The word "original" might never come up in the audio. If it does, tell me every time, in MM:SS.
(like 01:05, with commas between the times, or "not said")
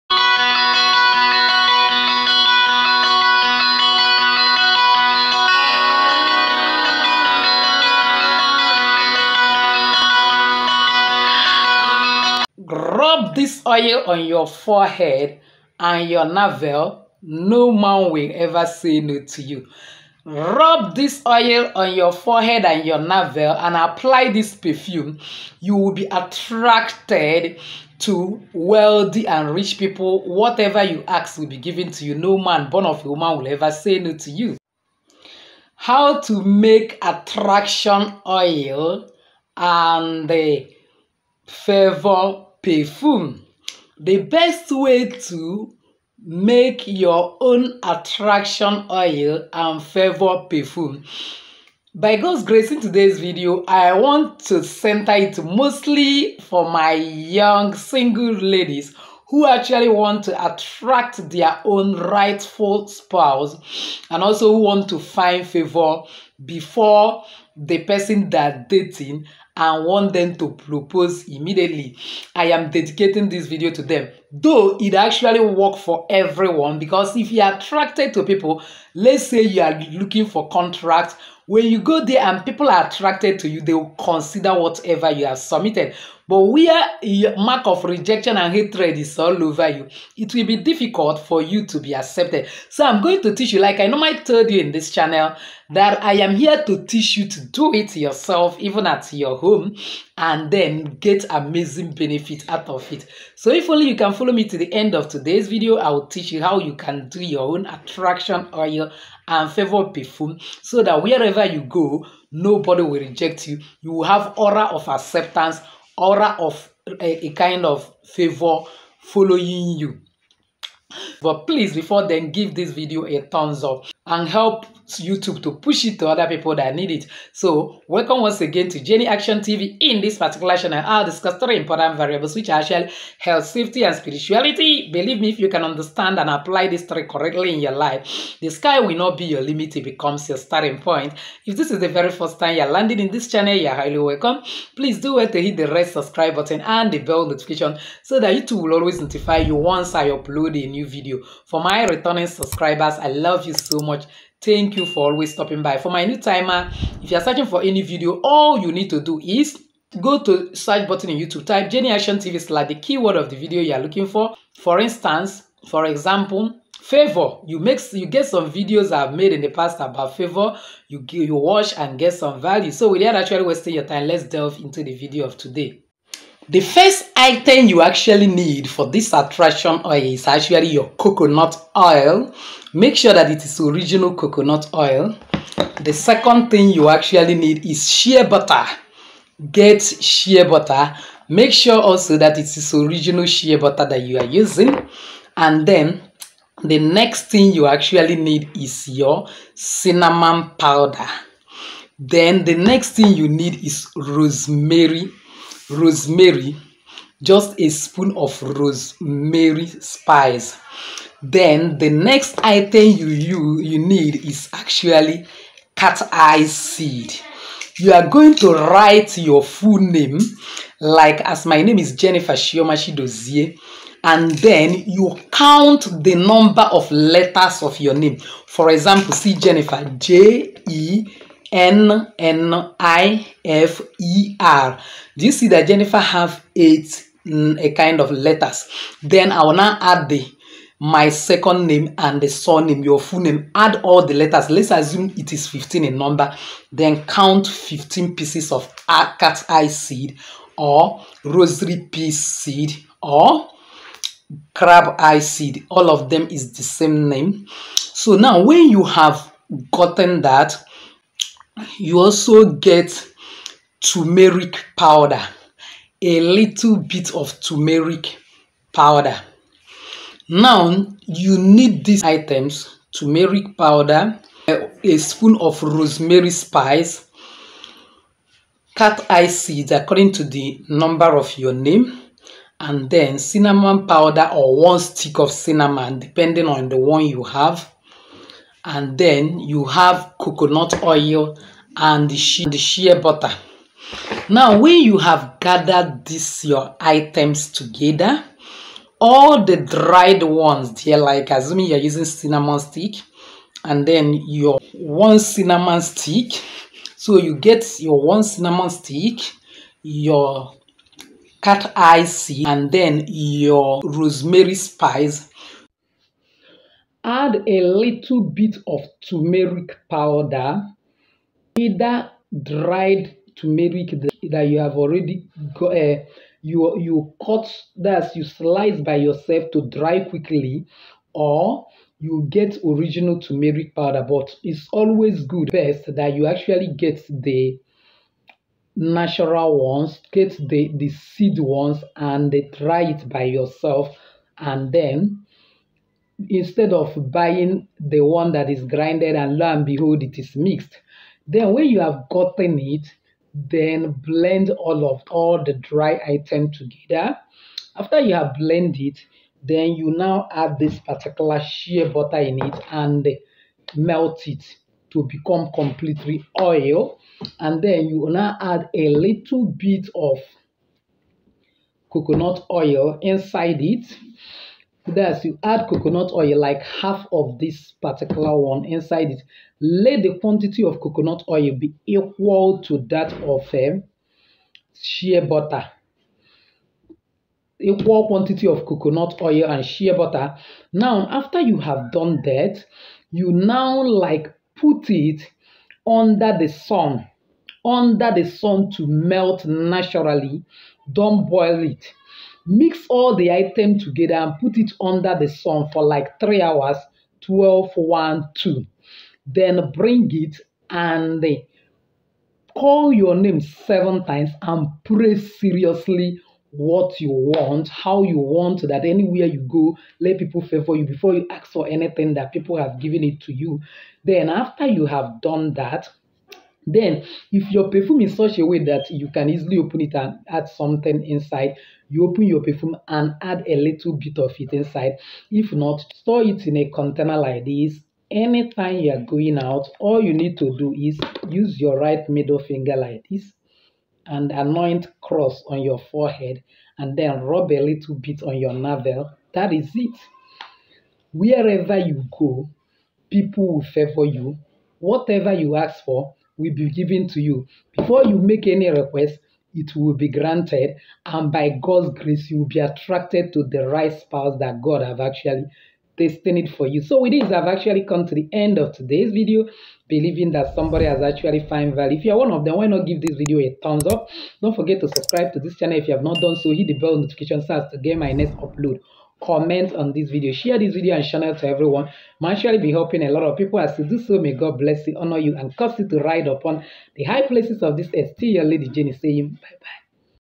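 03:03, 03:12, 05:32.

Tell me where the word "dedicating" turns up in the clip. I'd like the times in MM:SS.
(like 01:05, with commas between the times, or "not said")
01:12.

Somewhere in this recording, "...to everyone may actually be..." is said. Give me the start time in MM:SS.
08:01.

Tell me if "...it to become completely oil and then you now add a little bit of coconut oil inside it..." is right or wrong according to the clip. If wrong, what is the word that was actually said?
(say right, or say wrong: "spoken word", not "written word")
right.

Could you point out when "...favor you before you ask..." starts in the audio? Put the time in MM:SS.
07:00.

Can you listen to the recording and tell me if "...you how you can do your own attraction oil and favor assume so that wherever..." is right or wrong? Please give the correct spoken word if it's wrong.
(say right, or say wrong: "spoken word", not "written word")
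wrong: "perfume", not "assume".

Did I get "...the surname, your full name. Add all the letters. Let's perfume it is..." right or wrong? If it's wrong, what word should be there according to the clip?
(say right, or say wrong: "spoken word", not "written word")
wrong: "assume", not "perfume".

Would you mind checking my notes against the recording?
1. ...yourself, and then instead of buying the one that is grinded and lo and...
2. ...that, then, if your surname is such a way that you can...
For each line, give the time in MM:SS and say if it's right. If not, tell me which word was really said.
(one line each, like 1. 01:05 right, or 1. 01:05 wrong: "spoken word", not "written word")
1. 05:43 right
2. 07:05 wrong: "perfume", not "surname".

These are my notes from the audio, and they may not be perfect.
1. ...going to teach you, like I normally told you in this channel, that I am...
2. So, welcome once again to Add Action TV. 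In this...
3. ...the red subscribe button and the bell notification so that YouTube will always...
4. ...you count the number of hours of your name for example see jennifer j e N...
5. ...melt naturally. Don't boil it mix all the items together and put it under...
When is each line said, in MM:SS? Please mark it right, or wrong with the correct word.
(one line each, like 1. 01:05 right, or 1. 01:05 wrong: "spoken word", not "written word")
1. 01:33 right
2. 02:07 wrong: "Jenny", not "Add"
3. 02:25 right
4. 03:44 wrong: "letters", not "hours"
5. 06:38 right.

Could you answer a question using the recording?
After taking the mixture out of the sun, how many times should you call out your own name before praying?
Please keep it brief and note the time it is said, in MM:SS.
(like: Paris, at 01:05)
7, at 06:53.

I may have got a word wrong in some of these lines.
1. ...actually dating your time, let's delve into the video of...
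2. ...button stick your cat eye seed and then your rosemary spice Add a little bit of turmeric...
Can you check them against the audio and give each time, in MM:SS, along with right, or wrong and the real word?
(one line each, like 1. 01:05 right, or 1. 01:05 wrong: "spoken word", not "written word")
1. 02:53 wrong: "wasting", not "dating"
2. 05:08 wrong: "cinnamon", not "button".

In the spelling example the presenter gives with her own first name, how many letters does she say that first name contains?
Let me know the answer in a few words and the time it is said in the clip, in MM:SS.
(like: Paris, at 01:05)
8, at 03:56.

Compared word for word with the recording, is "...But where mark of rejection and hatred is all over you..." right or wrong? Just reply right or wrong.
right.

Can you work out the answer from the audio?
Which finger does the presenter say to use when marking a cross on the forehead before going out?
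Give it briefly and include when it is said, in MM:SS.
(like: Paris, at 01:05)
right middle finger, at 07:21.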